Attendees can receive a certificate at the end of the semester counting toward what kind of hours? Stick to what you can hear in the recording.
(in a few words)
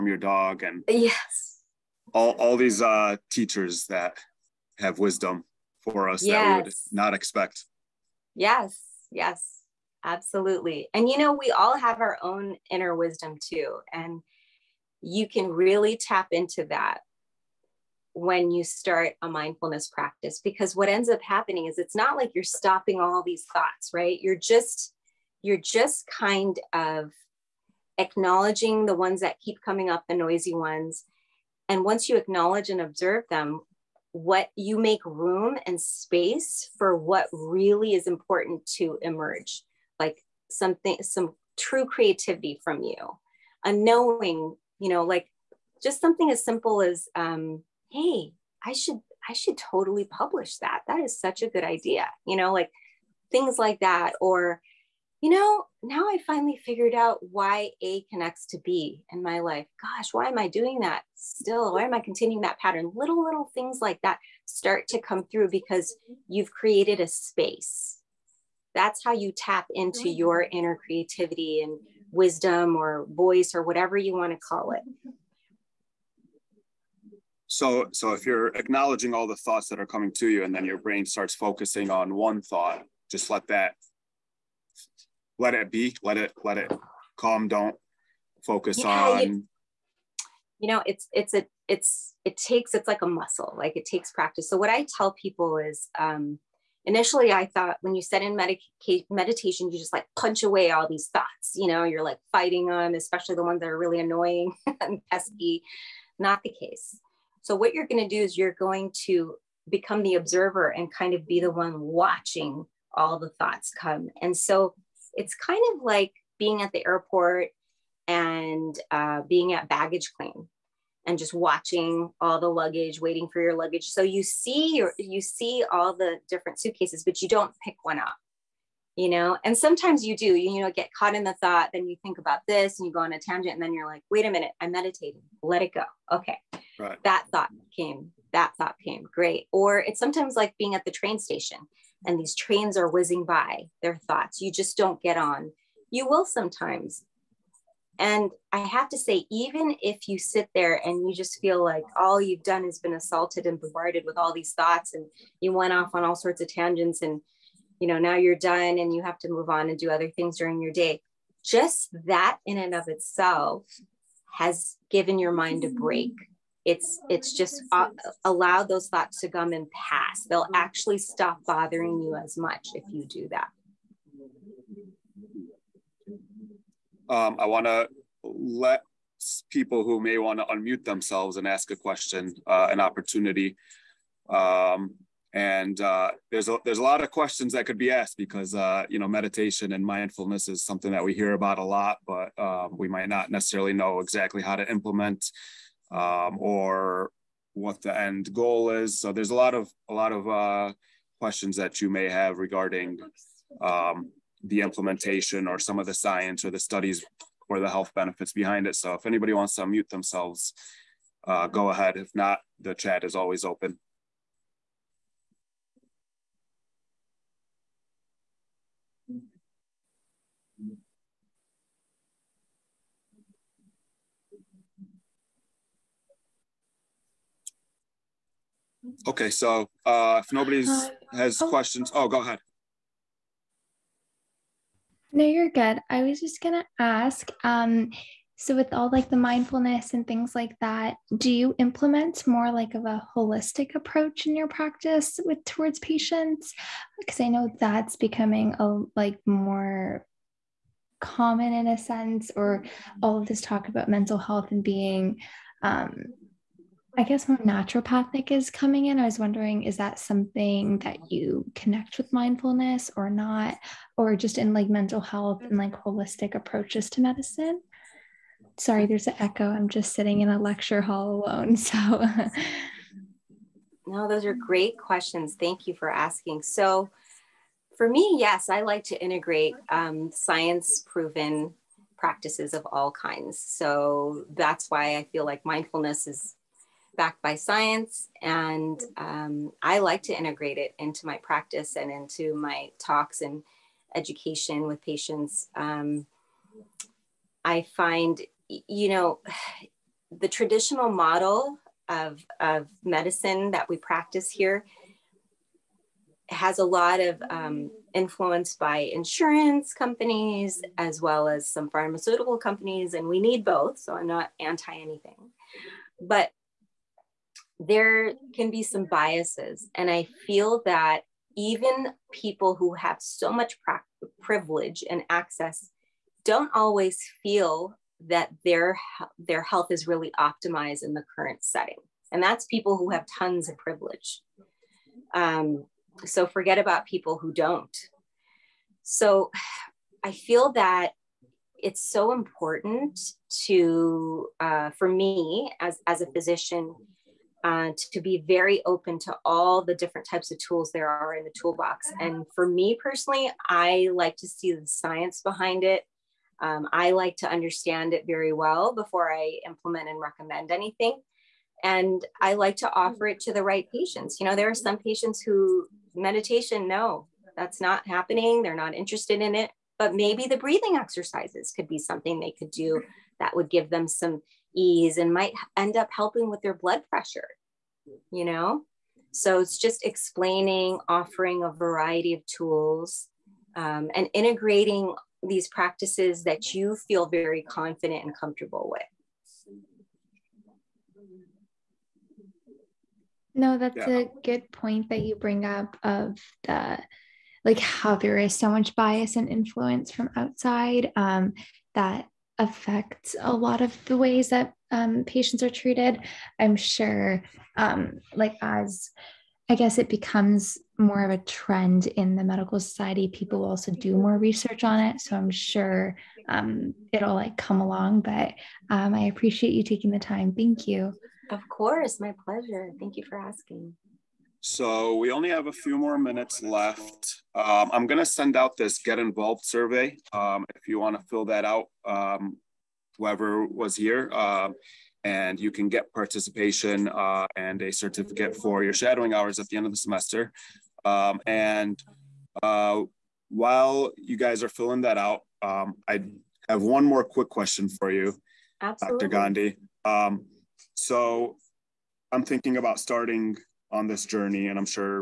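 shadowing hours.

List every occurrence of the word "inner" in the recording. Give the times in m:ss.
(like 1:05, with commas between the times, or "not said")
0:12, 1:10.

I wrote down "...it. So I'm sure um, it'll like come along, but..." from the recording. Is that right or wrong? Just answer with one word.
right.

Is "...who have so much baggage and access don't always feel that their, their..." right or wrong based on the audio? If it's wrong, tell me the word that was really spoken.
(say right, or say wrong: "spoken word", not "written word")
wrong: "privilege", not "baggage".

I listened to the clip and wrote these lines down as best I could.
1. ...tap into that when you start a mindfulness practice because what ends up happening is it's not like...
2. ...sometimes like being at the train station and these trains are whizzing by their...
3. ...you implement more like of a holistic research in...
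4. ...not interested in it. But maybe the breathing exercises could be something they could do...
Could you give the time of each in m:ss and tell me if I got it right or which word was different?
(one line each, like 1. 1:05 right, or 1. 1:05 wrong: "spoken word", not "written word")
1. 0:15 right
2. 2:20 right
3. 4:01 wrong: "approach", not "research"
4. 6:08 right.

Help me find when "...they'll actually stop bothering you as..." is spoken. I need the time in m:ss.
2:50.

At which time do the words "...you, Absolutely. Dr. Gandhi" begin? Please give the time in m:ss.
7:27.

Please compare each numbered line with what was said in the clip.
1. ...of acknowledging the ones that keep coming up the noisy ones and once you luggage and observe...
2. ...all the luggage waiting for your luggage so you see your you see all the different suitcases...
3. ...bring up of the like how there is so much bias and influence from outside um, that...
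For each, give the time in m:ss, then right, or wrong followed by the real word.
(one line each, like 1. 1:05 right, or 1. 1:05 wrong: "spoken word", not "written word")
1. 0:26 wrong: "acknowledge", not "luggage"
2. 2:02 right
3. 6:35 right.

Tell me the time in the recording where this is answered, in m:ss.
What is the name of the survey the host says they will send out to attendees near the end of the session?
7:08.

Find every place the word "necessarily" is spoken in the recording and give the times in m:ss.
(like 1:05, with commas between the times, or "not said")
3:13.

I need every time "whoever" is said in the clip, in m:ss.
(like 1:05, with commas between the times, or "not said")
7:12.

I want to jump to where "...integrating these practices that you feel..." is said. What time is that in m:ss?
6:24.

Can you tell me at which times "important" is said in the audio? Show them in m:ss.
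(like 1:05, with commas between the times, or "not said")
0:38, 5:42.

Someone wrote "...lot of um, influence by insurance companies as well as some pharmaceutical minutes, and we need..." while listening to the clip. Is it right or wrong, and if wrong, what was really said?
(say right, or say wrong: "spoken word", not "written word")
wrong: "companies", not "minutes".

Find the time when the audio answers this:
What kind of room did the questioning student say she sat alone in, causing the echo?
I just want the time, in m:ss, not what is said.
4:30.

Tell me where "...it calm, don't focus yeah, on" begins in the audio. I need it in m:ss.
1:26.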